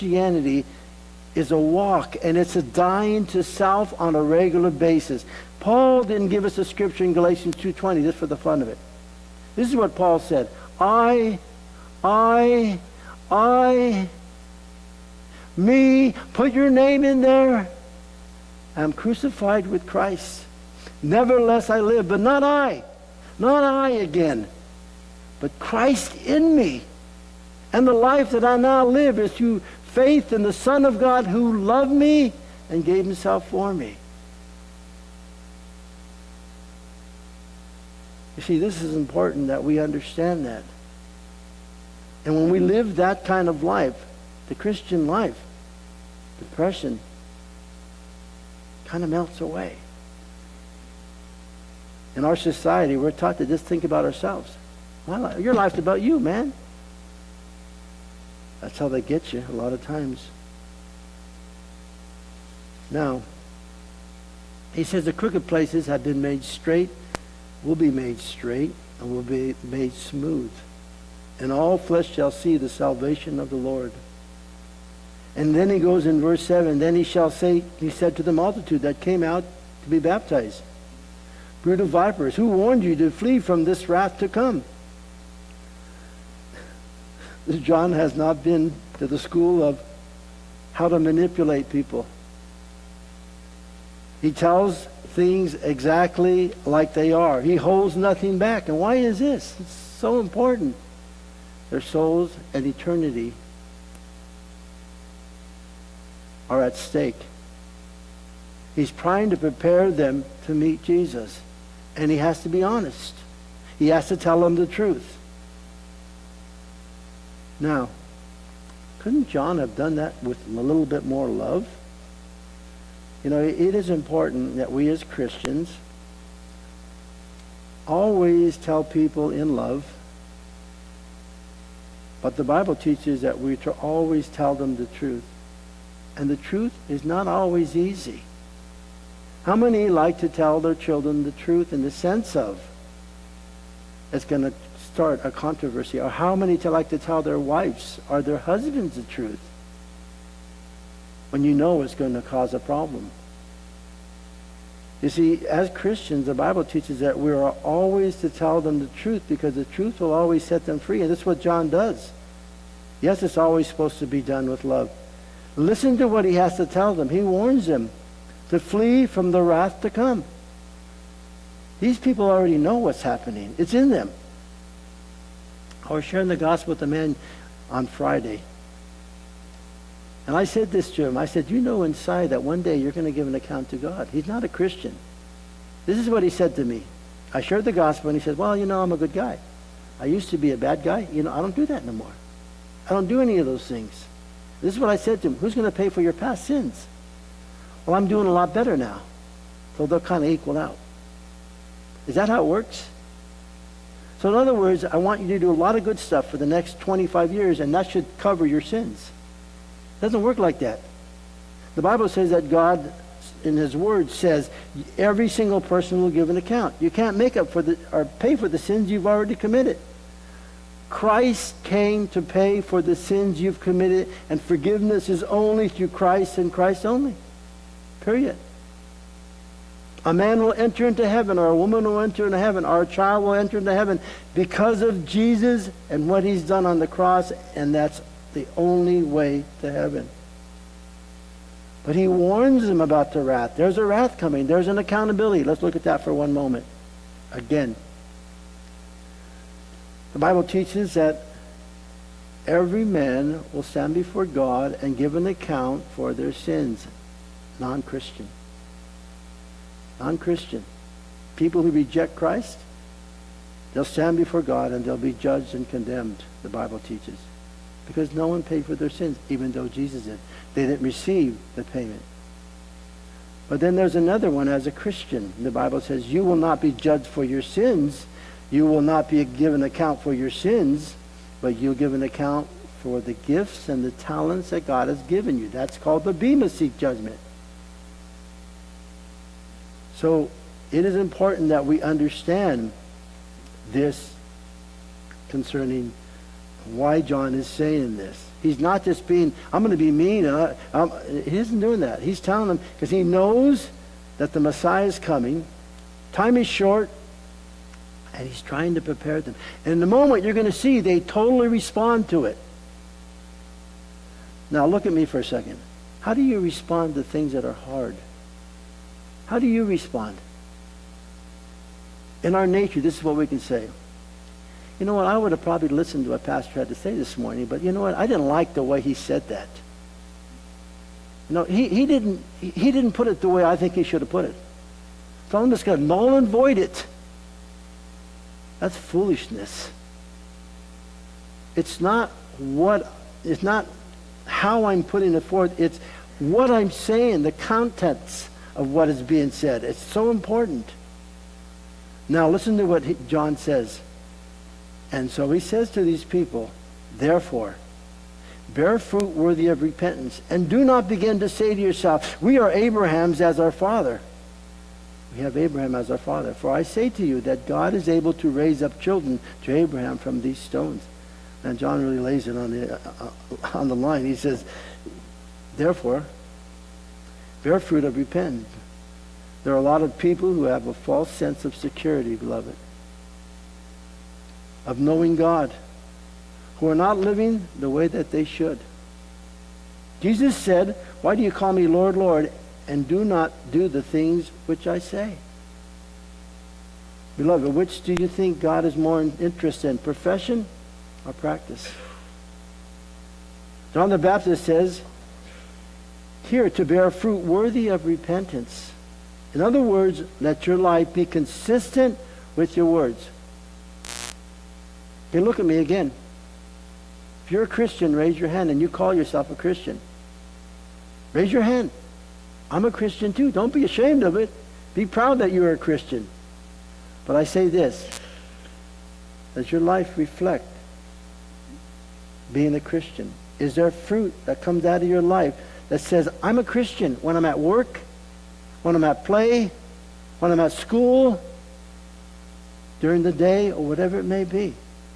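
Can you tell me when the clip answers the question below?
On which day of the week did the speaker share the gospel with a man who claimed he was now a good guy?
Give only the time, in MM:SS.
02:57.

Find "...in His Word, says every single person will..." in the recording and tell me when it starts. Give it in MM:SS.
03:33.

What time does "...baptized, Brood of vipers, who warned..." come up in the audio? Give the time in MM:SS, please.
01:19.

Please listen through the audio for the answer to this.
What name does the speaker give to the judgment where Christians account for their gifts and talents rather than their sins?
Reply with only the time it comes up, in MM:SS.
04:46.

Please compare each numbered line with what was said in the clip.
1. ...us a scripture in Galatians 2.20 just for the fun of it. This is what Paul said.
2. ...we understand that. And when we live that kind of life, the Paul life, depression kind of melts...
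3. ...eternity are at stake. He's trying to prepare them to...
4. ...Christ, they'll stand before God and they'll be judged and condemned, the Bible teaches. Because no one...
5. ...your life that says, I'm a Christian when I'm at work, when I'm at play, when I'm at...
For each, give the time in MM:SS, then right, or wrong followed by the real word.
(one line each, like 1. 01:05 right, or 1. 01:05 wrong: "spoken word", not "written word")
1. 00:06 right
2. 00:39 wrong: "Christian", not "Paul"
3. 01:42 right
4. 04:22 right
5. 07:14 right.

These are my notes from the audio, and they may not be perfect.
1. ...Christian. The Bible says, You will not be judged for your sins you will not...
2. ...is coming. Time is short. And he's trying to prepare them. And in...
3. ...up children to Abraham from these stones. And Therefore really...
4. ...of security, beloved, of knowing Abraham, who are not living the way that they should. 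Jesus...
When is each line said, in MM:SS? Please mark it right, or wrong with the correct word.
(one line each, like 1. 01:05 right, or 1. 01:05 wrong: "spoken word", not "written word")
1. 04:34 right
2. 05:04 right
3. 06:08 wrong: "John", not "Therefore"
4. 06:21 wrong: "God", not "Abraham".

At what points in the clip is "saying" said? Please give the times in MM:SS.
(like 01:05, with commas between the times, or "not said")
04:57, 05:46.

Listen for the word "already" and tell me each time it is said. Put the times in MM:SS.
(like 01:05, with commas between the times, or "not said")
02:52, 03:39.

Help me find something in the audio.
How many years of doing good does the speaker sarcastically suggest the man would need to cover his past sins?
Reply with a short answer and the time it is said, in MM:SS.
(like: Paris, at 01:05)
25, at 03:26.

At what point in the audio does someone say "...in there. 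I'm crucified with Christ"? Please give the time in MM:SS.
00:17.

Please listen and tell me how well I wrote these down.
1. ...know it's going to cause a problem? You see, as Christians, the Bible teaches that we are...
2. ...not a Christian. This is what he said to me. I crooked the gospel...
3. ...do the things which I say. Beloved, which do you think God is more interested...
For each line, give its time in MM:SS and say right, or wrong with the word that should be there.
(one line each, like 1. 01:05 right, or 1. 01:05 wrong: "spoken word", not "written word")
1. 02:31 right
2. 03:04 wrong: "shared", not "crooked"
3. 06:33 right.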